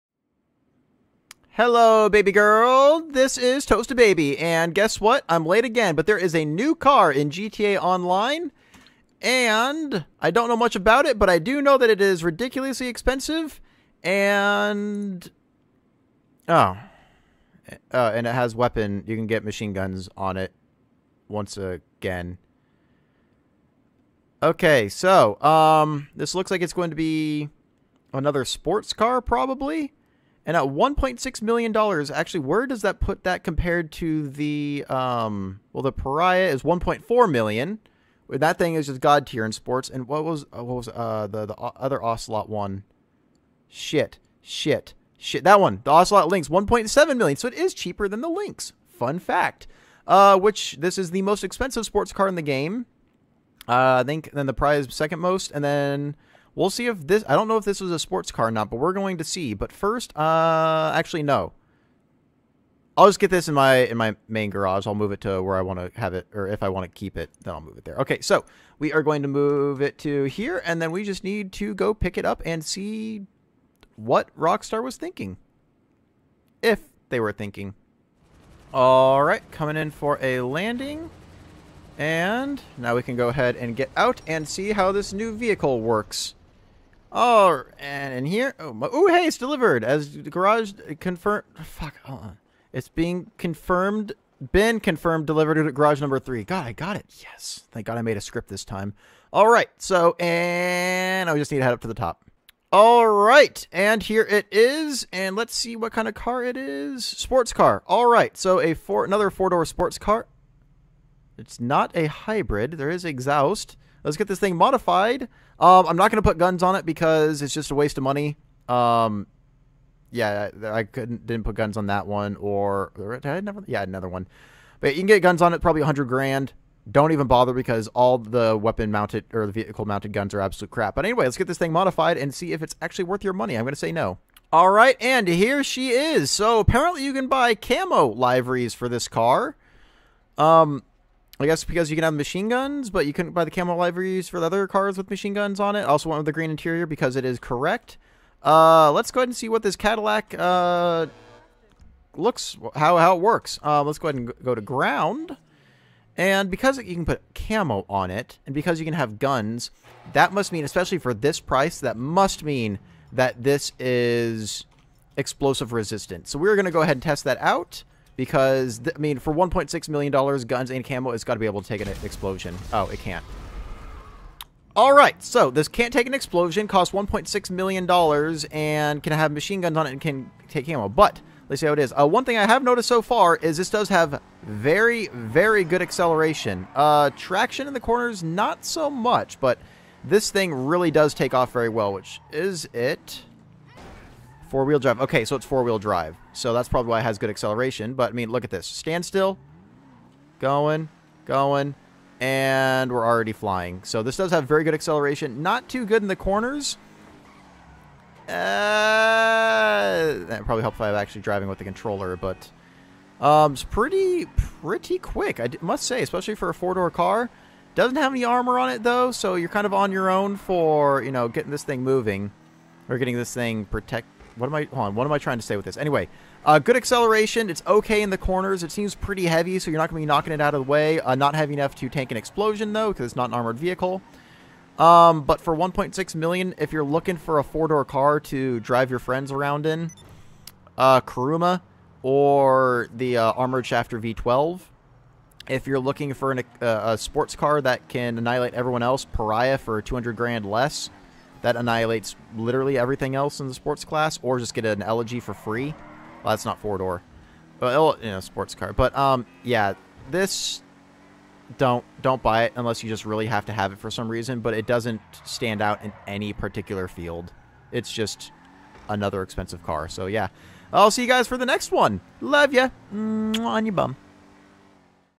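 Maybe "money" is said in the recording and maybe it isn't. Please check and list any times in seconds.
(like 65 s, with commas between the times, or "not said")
118 s, 133 s.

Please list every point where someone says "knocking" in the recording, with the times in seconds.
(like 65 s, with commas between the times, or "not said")
230 s.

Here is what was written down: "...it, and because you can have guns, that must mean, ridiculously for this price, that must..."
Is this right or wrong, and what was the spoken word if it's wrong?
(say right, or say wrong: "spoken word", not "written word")
wrong: "especially", not "ridiculously".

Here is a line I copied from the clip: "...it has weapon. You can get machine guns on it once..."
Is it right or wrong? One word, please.
right.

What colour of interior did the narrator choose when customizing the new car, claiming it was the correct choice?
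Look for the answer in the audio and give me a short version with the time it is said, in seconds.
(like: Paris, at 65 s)
green, at 146 s.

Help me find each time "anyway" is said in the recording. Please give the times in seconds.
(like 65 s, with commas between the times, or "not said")
131 s, 225 s.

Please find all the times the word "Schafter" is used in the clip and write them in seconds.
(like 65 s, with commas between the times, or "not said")
243 s.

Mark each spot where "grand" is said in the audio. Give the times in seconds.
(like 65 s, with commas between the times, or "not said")
126 s, 250 s.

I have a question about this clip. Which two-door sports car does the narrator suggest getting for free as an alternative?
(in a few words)
Elegy.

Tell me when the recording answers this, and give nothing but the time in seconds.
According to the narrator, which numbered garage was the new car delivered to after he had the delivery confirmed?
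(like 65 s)
95 s.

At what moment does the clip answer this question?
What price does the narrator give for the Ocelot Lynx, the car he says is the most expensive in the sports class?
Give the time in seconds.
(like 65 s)
46 s.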